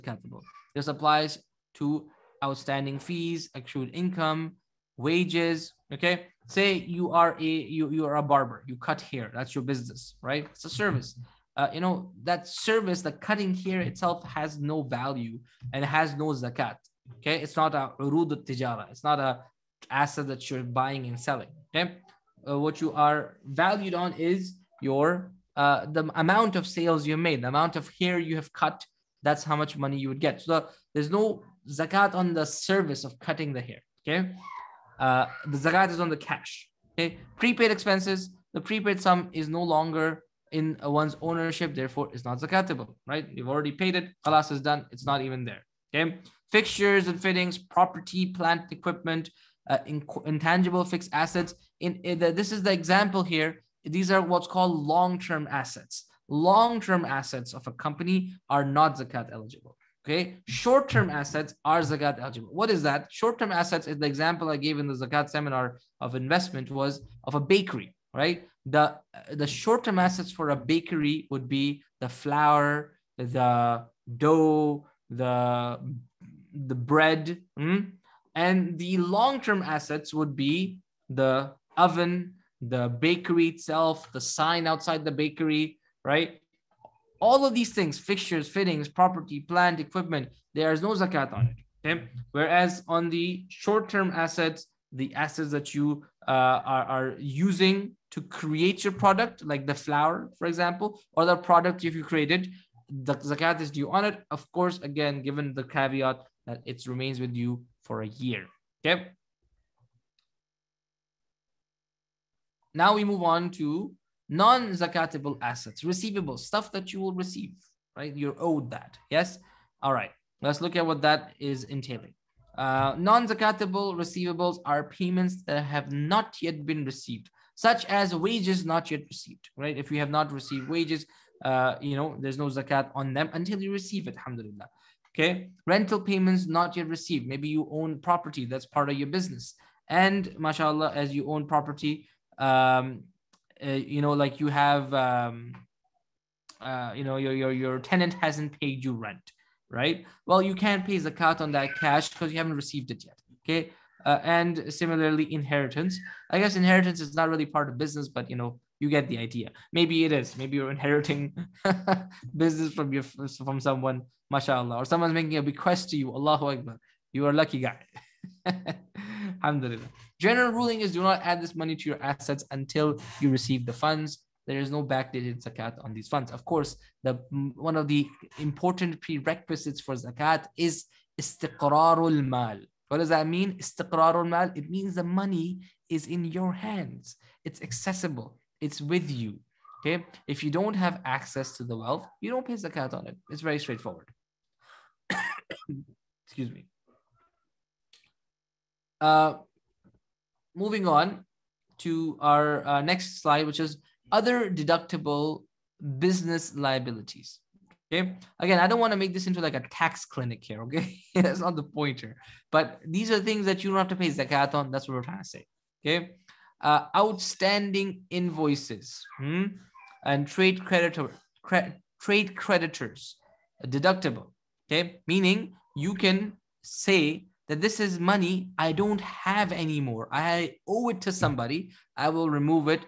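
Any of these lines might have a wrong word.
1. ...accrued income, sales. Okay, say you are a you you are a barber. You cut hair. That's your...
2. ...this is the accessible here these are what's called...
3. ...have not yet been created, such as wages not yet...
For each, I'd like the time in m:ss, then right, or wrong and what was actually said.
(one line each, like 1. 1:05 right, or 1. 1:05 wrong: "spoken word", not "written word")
1. 0:03 wrong: "wages", not "sales"
2. 0:52 wrong: "example", not "accessible"
3. 2:05 wrong: "received", not "created".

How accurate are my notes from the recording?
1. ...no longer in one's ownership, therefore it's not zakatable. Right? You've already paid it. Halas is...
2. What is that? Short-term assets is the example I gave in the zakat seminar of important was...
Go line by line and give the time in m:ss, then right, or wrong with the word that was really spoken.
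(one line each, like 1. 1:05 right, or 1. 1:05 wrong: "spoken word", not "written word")
1. 0:39 right
2. 1:02 wrong: "investment", not "important".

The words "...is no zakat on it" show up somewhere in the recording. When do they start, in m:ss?
1:30.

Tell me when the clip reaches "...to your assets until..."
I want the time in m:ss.
2:51.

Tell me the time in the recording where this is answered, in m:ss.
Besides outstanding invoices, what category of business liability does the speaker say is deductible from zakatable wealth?
3:41.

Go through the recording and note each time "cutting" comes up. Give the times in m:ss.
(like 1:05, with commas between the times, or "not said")
0:13, 0:33.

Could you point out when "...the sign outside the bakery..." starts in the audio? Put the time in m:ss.
1:24.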